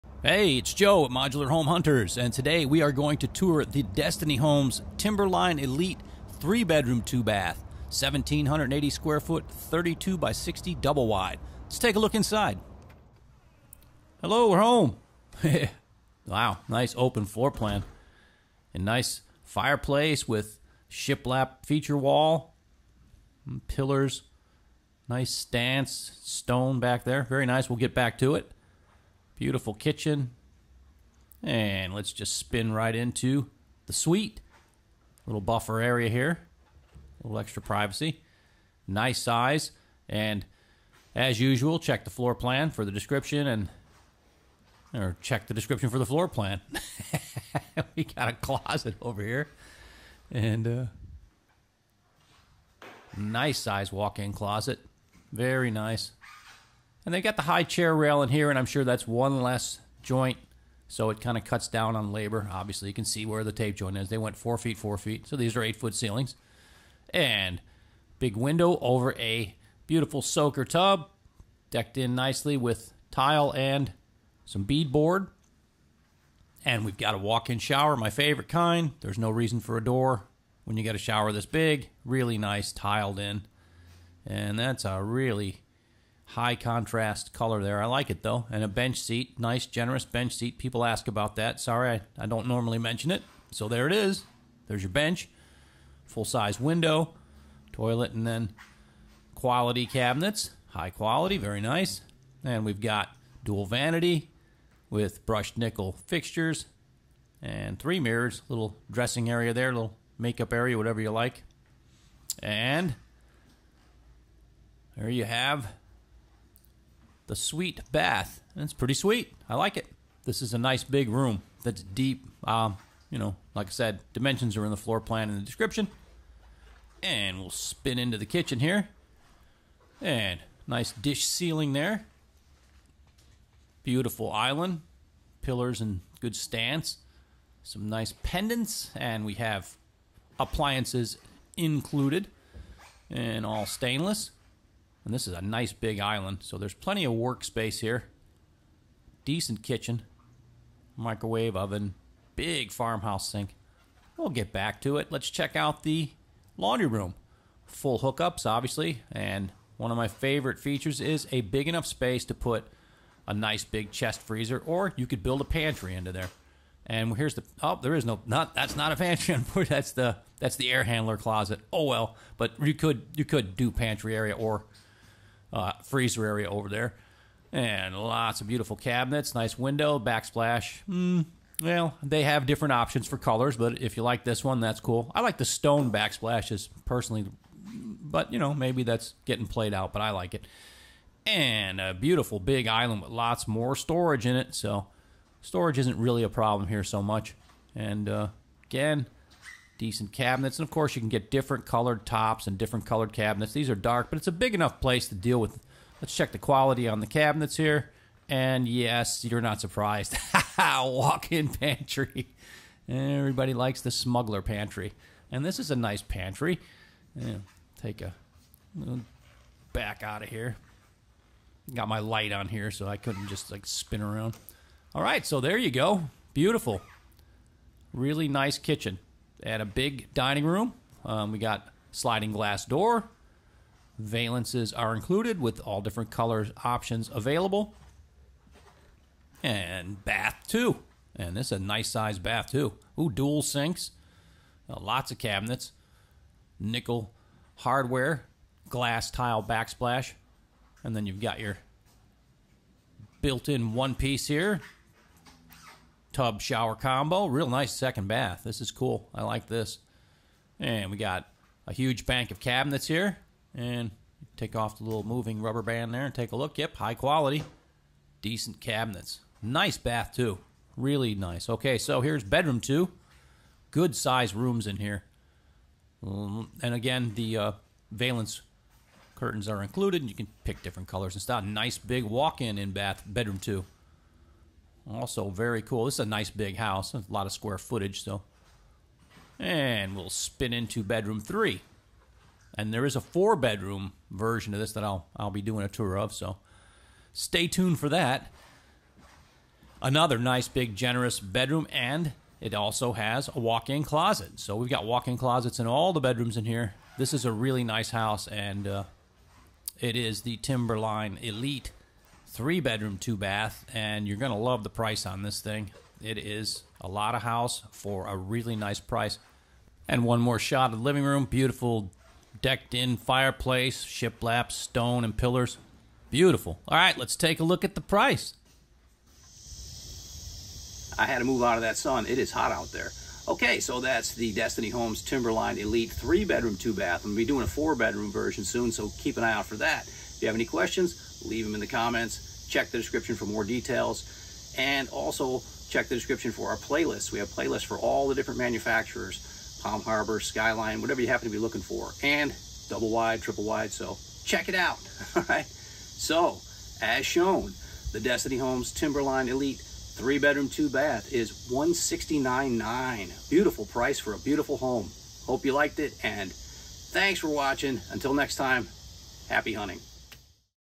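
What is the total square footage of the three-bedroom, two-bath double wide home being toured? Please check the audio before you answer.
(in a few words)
1780.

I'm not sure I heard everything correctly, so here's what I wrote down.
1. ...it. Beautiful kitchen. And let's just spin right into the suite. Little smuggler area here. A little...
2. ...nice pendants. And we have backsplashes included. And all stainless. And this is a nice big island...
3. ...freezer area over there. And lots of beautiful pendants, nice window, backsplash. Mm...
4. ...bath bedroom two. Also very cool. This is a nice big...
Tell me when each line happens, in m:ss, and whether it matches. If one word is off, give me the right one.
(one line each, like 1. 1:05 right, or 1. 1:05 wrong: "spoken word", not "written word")
1. 0:28 wrong: "buffer", not "smuggler"
2. 2:17 wrong: "appliances", not "backsplashes"
3. 2:55 wrong: "cabinets", not "pendants"
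4. 4:42 right.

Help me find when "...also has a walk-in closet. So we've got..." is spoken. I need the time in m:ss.
5:02.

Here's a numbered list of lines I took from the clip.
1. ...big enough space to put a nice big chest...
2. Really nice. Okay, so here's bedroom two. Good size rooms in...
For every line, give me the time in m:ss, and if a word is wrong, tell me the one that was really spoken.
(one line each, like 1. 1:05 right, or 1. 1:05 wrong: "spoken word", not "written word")
1. 2:41 right
2. 4:30 right.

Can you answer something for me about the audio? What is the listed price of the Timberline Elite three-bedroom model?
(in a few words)
$169,900.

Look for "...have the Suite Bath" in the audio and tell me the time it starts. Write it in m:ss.
1:55.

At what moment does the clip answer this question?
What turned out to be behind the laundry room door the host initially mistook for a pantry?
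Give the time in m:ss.
2:50.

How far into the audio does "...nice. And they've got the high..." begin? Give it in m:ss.
0:55.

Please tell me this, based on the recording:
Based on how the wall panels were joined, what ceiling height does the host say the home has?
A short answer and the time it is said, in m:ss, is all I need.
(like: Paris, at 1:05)
8 feet, at 1:05.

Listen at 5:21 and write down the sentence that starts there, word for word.
Beautiful decked in fireplace, shiplap, stone, and pillars.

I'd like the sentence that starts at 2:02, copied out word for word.
Um, you know, like I said, dimensions are in the floor plan in the description.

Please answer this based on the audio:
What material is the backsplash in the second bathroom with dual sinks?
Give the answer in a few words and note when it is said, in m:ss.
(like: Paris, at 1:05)
Glass tile, at 4:08.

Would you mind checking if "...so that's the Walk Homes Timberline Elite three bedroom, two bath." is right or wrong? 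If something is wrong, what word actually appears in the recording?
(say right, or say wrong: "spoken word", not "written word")
wrong: "Destiny", not "Walk".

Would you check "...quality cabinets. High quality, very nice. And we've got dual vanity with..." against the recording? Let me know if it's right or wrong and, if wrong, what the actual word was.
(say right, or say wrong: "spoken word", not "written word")
right.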